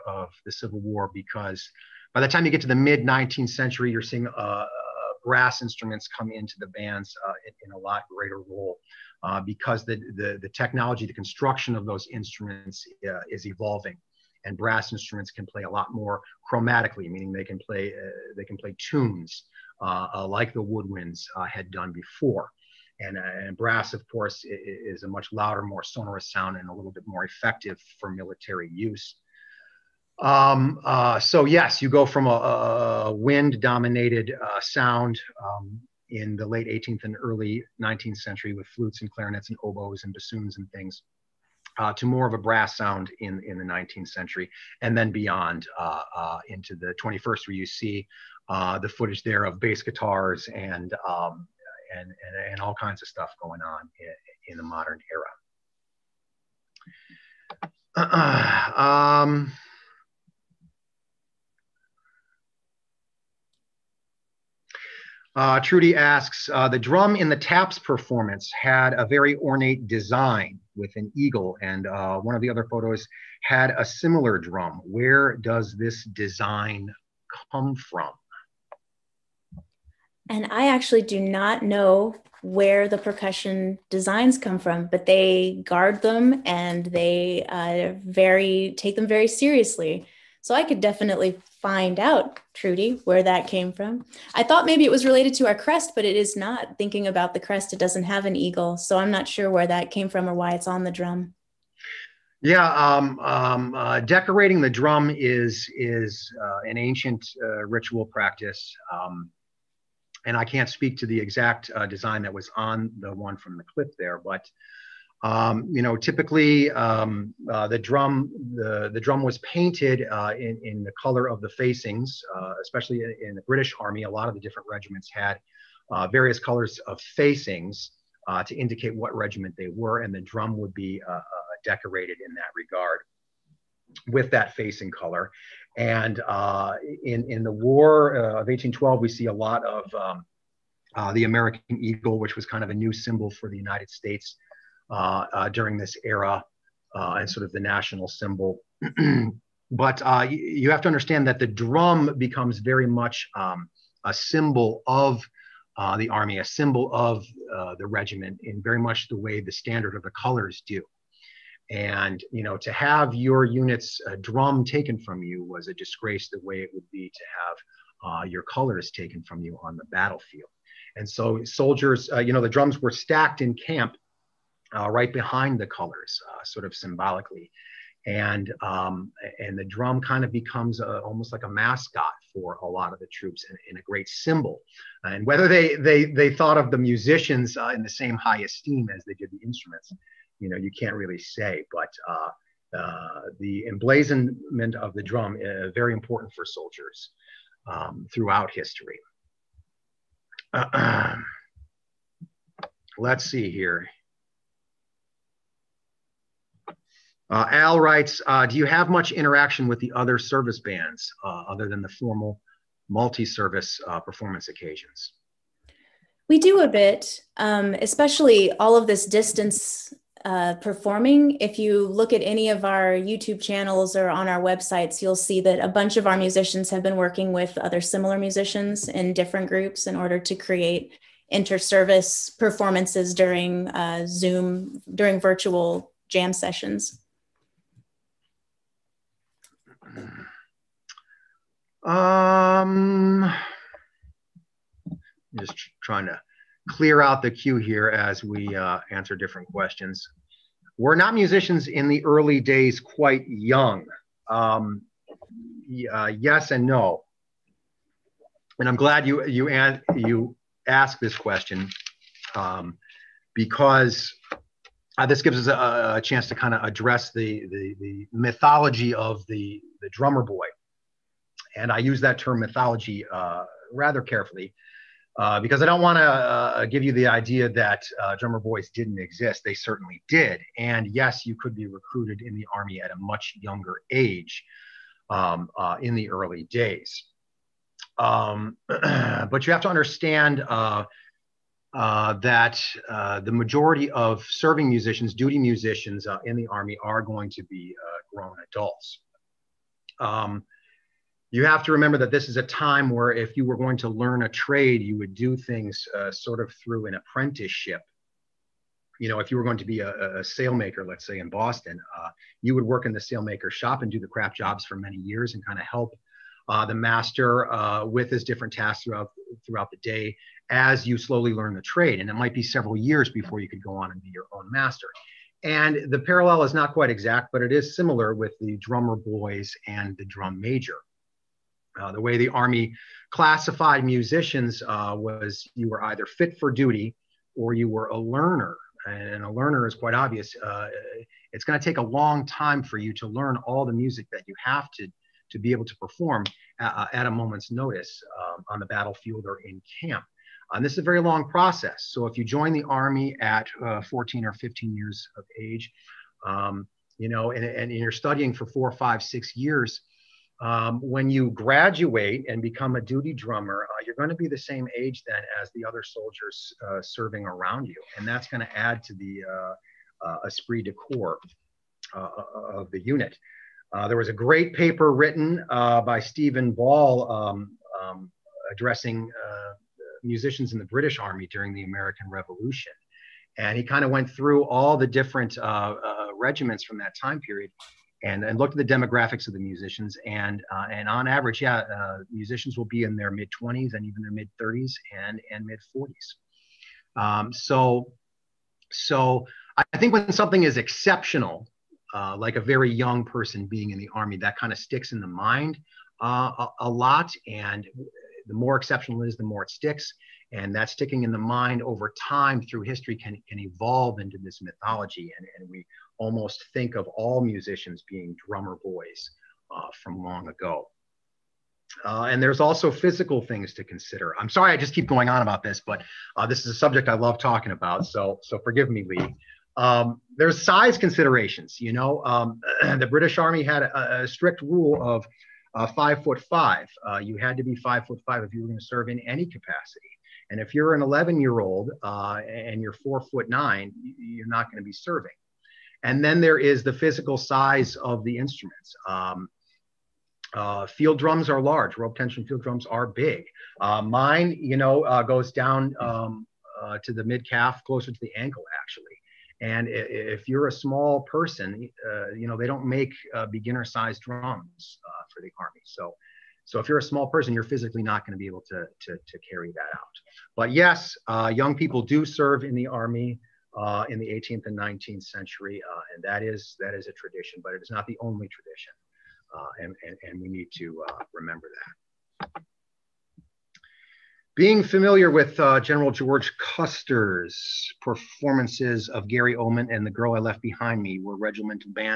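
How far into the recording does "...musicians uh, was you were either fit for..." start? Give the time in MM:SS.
05:33.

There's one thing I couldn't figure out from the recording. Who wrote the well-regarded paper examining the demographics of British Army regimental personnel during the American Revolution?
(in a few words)
Stephen Ball.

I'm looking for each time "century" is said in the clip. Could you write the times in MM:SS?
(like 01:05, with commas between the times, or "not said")
00:03, 00:38, 00:44, 07:55.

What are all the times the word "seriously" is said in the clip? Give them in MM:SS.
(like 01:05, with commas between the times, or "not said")
01:29.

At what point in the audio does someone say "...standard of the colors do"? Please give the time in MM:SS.
02:39.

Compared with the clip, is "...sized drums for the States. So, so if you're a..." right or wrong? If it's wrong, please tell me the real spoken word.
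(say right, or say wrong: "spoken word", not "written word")
wrong: "Army", not "States".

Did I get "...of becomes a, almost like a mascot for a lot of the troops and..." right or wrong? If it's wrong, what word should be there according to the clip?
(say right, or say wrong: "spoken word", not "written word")
right.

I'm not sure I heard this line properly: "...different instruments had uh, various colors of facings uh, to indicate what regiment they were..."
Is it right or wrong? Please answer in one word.
wrong.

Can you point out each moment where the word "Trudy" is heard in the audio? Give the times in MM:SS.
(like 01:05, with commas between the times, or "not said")
01:05, 01:32.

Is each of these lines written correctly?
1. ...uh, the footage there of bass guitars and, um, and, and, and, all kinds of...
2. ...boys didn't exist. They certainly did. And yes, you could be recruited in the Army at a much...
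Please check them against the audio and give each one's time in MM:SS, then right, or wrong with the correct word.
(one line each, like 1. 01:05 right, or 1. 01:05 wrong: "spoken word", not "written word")
1. 00:48 right
2. 04:38 right.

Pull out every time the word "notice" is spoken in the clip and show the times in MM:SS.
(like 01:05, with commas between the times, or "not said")
05:47.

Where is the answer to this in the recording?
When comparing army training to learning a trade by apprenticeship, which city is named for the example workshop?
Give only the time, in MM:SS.
05:11.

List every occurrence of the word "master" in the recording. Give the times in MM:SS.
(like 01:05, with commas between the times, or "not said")
05:16, 05:24.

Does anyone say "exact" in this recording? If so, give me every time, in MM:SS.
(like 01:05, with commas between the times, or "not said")
01:51, 05:26.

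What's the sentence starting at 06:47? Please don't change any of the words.
And the more exceptional it is, the more it sticks.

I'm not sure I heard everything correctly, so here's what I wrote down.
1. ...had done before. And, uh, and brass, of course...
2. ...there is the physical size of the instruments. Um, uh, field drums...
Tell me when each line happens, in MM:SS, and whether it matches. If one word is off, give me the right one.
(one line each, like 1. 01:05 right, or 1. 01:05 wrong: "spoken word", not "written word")
1. 00:21 right
2. 07:26 right.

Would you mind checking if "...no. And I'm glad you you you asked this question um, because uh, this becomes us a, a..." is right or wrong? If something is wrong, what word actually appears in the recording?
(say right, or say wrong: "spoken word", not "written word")
wrong: "gives", not "becomes".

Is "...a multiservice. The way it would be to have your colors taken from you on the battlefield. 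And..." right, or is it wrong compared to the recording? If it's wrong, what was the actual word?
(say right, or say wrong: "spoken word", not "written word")
wrong: "disgrace", not "multiservice".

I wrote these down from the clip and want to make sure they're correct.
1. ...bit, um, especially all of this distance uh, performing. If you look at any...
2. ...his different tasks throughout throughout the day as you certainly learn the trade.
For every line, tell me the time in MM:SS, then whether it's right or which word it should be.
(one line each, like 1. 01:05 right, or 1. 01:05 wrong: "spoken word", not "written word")
1. 03:36 right
2. 05:18 wrong: "slowly", not "certainly".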